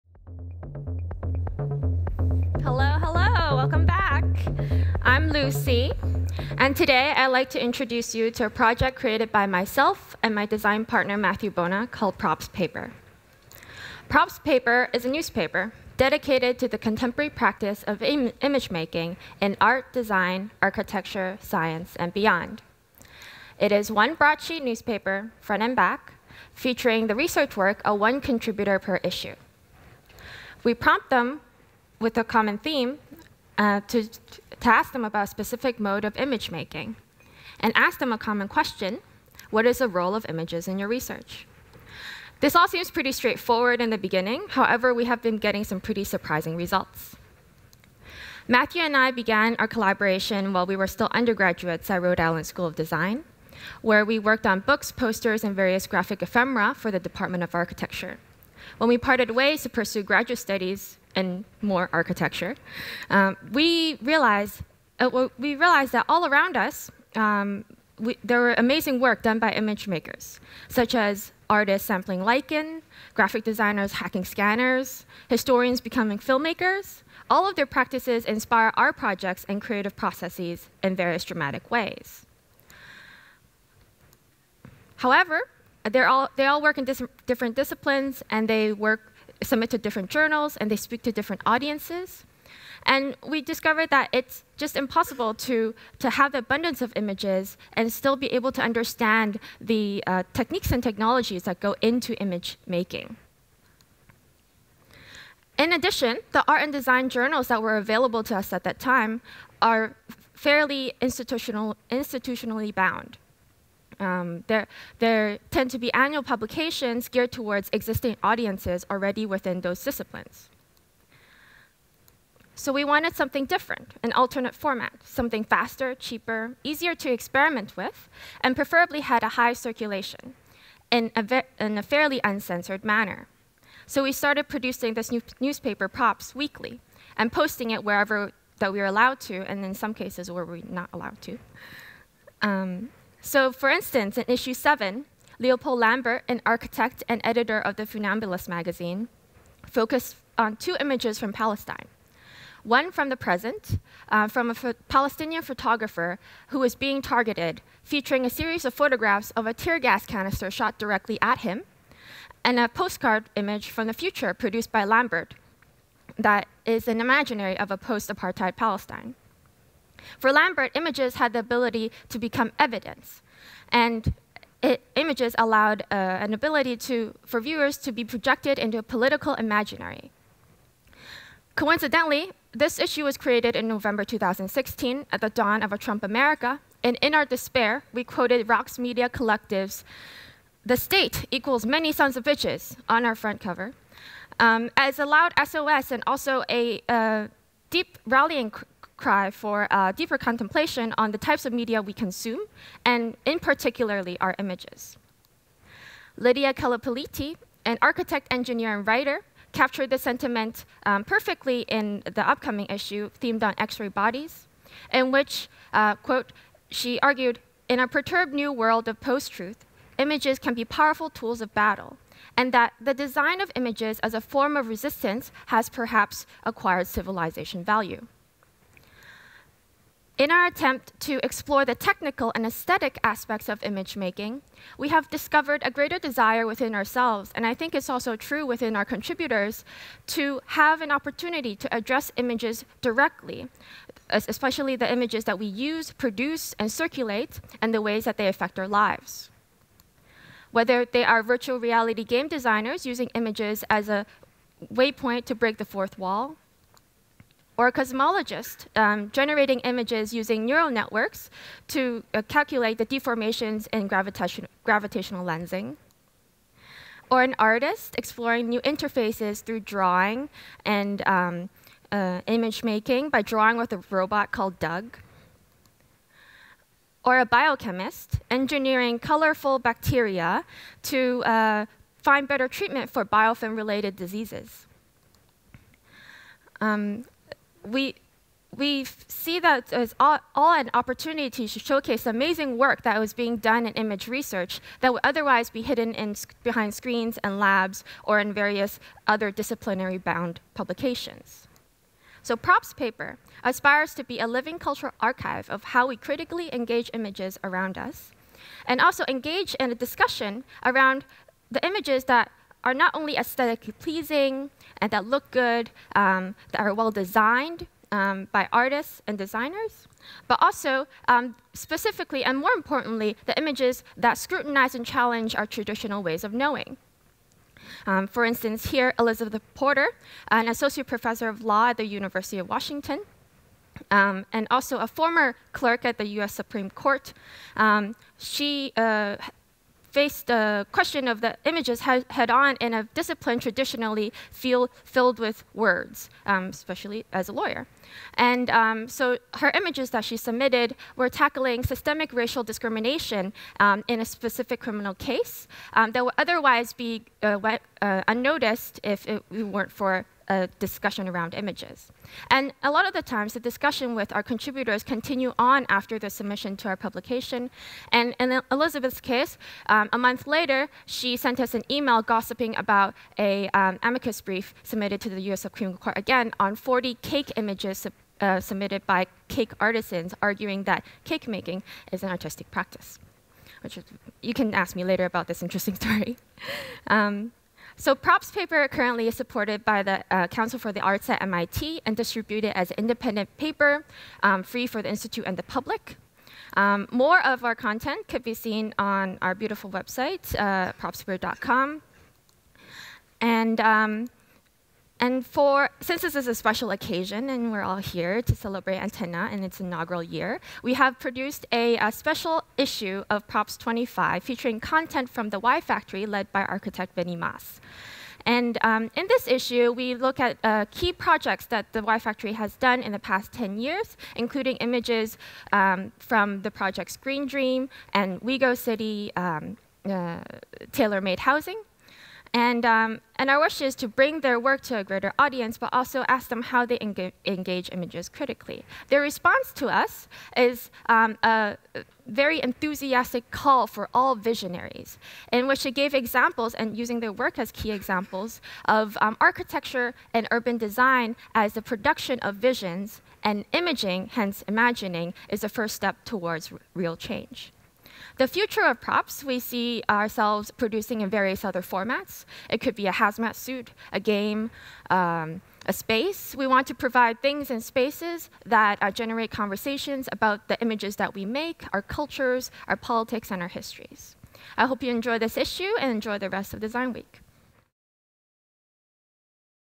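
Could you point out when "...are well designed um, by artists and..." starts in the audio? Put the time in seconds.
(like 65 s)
316 s.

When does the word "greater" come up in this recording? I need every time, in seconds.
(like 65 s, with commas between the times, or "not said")
235 s, 434 s.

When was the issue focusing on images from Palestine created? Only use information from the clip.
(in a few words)
November 2016.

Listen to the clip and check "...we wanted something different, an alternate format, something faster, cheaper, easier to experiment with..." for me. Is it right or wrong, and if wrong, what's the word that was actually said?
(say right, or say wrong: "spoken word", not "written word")
right.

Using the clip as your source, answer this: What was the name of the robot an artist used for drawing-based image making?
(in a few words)
Doug.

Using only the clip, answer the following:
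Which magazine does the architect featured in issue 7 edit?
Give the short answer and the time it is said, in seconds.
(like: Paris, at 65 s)
The Funambulist, at 147 s.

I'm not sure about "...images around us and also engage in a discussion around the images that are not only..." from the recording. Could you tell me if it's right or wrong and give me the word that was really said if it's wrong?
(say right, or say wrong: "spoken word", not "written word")
right.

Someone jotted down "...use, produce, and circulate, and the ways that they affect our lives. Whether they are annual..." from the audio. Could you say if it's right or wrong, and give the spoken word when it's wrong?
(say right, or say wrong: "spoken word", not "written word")
wrong: "virtual", not "annual".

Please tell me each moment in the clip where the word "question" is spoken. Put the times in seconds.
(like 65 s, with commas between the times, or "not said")
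38 s, 340 s.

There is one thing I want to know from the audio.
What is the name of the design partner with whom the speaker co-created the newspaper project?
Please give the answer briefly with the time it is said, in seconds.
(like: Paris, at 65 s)
Matthew Bona, at 11 s.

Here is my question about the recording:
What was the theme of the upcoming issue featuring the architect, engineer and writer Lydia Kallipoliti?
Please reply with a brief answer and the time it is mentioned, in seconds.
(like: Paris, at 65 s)
X-ray bodies, at 213 s.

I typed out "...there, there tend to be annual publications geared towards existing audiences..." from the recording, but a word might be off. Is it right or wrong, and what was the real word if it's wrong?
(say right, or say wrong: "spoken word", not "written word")
right.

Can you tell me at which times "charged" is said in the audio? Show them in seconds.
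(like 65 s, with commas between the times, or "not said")
not said.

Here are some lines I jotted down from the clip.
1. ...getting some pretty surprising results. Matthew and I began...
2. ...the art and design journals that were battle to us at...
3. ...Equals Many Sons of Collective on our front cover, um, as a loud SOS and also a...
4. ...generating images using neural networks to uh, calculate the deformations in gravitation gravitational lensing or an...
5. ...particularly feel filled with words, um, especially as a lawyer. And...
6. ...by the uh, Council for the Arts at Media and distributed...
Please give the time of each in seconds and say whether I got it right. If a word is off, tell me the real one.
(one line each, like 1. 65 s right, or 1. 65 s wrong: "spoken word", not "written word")
1. 45 s right
2. 106 s wrong: "available", not "battle"
3. 191 s wrong: "Bitches", not "Collective"
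4. 259 s right
5. 343 s wrong: "traditionally", not "particularly"
6. 389 s wrong: "MIT", not "Media".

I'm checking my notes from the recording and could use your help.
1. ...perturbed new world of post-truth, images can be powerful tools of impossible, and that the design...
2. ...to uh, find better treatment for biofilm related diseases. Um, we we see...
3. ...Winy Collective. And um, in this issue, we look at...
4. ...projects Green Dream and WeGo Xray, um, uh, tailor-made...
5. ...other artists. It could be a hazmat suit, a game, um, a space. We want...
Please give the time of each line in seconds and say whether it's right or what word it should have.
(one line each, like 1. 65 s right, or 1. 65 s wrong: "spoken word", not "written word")
1. 217 s wrong: "battle", not "impossible"
2. 280 s right
3. 416 s wrong: "Maas", not "Collective"
4. 426 s wrong: "City", not "Xray"
5. 461 s wrong: "formats", not "artists".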